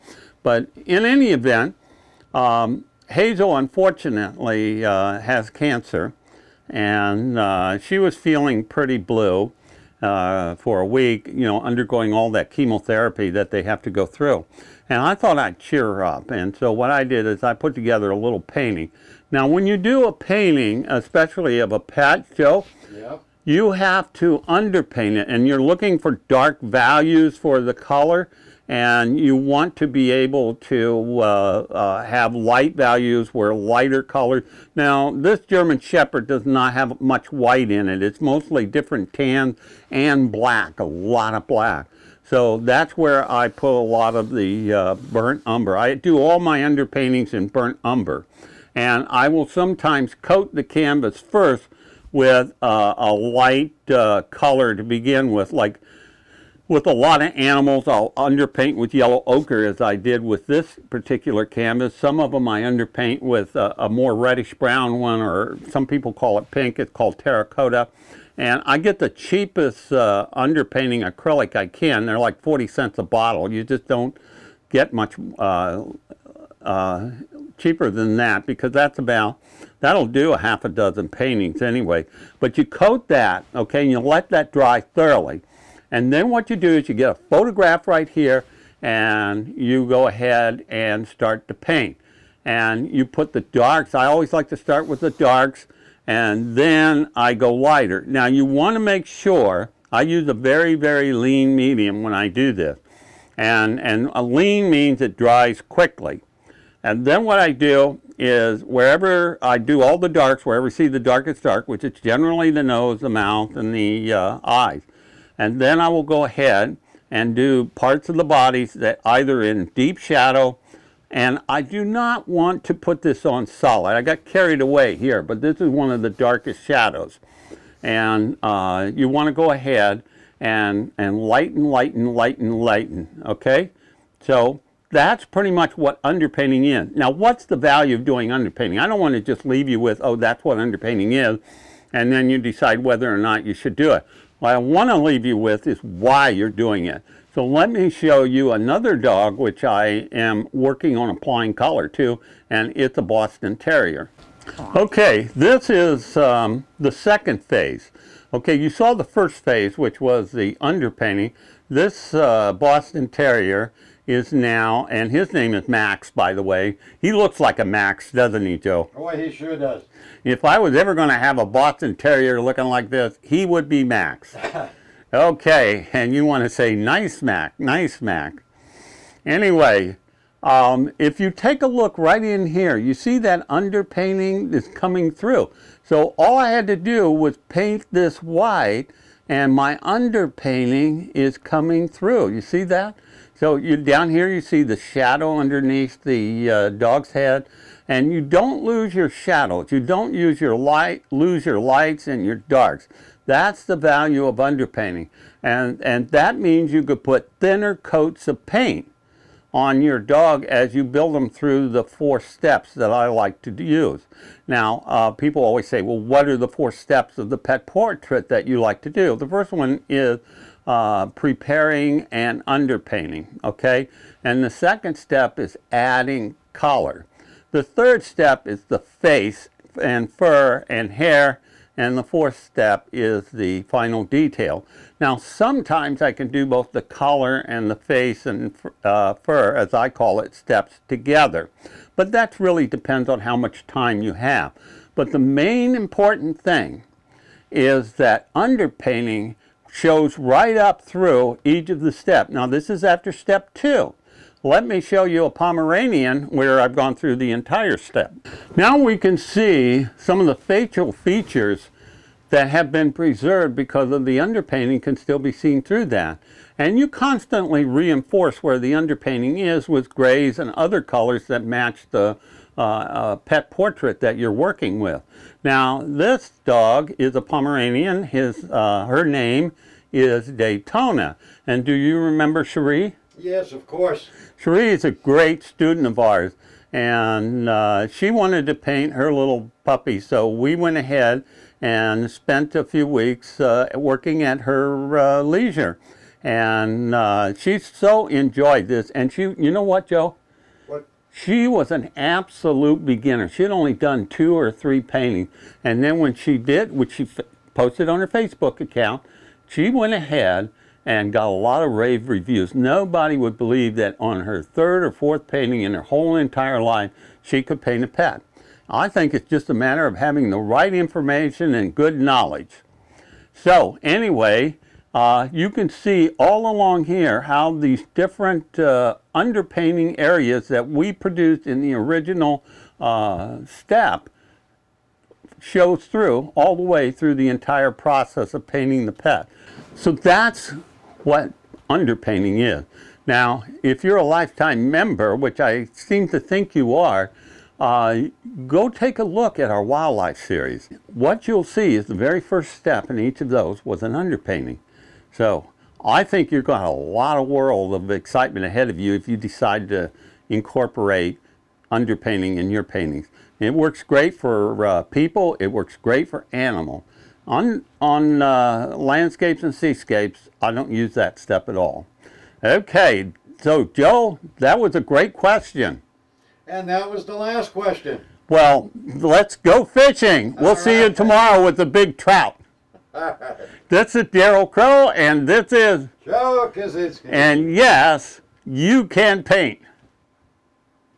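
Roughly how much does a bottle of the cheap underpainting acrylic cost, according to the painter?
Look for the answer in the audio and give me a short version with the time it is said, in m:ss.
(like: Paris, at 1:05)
40 cents, at 1:12.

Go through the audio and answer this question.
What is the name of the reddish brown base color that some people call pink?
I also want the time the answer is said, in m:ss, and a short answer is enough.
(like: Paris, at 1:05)
Terracotta, at 1:07.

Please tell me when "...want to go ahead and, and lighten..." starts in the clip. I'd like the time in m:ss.
2:09.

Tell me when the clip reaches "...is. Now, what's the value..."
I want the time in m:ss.
2:16.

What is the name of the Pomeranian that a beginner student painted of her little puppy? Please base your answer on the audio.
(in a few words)
Daytona.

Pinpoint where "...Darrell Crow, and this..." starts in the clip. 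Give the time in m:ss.
6:24.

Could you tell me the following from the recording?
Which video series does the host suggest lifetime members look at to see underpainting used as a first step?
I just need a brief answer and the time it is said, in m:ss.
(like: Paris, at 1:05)
Wildlife series, at 5:49.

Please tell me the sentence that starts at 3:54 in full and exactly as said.
Now, sometimes I can do both the collar and the face and uh, fur, as I call it, steps together.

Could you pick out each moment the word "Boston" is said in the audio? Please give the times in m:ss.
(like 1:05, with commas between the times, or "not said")
2:33, 2:42, 2:51.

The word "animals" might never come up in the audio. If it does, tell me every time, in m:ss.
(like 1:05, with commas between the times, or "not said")
0:57, 6:06.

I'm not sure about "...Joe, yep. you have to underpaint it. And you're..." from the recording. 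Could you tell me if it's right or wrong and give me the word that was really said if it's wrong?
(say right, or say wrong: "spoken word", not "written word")
right.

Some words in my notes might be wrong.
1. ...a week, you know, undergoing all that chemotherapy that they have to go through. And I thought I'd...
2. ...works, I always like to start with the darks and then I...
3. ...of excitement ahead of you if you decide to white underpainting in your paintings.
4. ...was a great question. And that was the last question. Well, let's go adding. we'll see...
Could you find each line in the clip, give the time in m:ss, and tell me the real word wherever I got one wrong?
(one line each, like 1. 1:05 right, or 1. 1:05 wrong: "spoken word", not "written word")
1. 0:10 right
2. 1:33 wrong: "darks", not "works"
3. 5:57 wrong: "incorporate", not "white"
4. 6:14 wrong: "fishing", not "adding".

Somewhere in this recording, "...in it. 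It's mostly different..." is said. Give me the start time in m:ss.
0:37.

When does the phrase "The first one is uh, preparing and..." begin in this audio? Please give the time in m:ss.
3:39.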